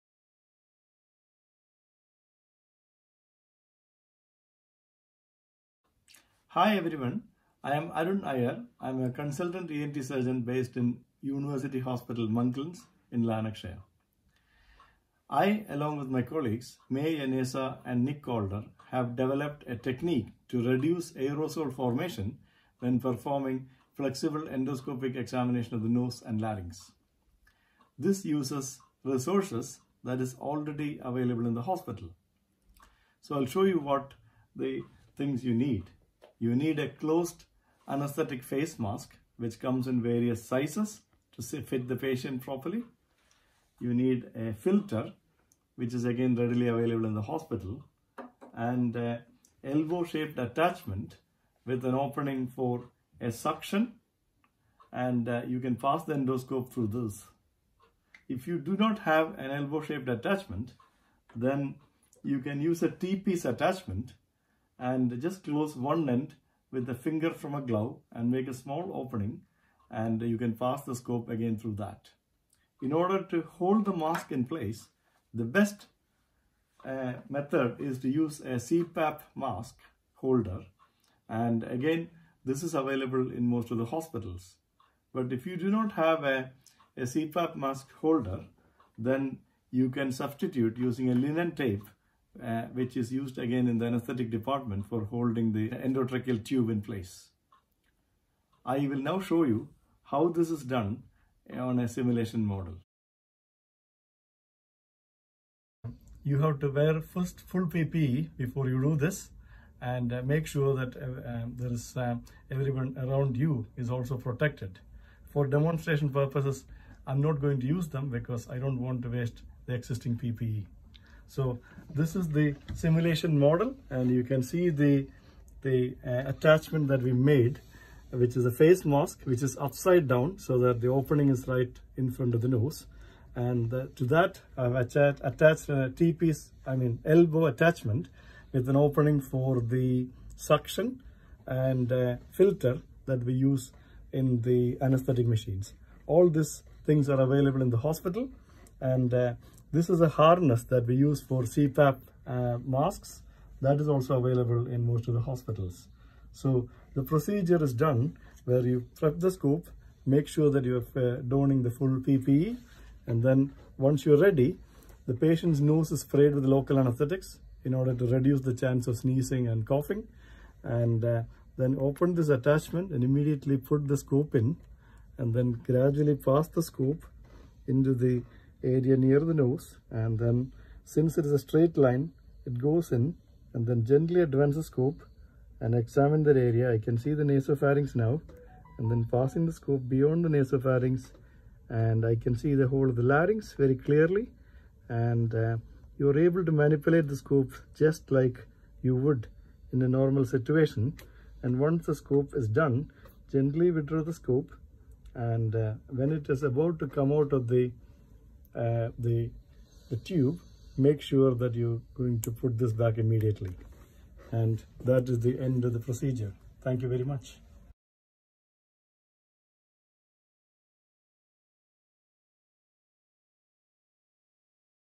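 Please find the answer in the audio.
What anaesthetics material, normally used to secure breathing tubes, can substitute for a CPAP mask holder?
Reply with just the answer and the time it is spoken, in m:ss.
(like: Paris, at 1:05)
linen tape, at 1:31.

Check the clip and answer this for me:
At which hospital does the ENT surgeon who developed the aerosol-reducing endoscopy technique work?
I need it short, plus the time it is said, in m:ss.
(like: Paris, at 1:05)
University Hospital Monklands, at 0:11.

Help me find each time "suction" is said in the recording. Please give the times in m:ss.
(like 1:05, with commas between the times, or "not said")
0:53, 2:20.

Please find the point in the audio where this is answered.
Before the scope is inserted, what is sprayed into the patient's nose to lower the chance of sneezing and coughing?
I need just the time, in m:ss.
2:46.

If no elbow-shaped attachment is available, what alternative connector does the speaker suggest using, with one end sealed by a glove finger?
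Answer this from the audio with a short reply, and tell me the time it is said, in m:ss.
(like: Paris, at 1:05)
T-piece attachment, at 1:02.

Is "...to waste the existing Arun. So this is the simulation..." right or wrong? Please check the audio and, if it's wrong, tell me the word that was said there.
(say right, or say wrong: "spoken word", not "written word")
wrong: "PPE", not "Arun".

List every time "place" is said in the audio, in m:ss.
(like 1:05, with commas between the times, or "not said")
1:14, 1:36.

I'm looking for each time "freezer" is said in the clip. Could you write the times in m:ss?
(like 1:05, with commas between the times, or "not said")
not said.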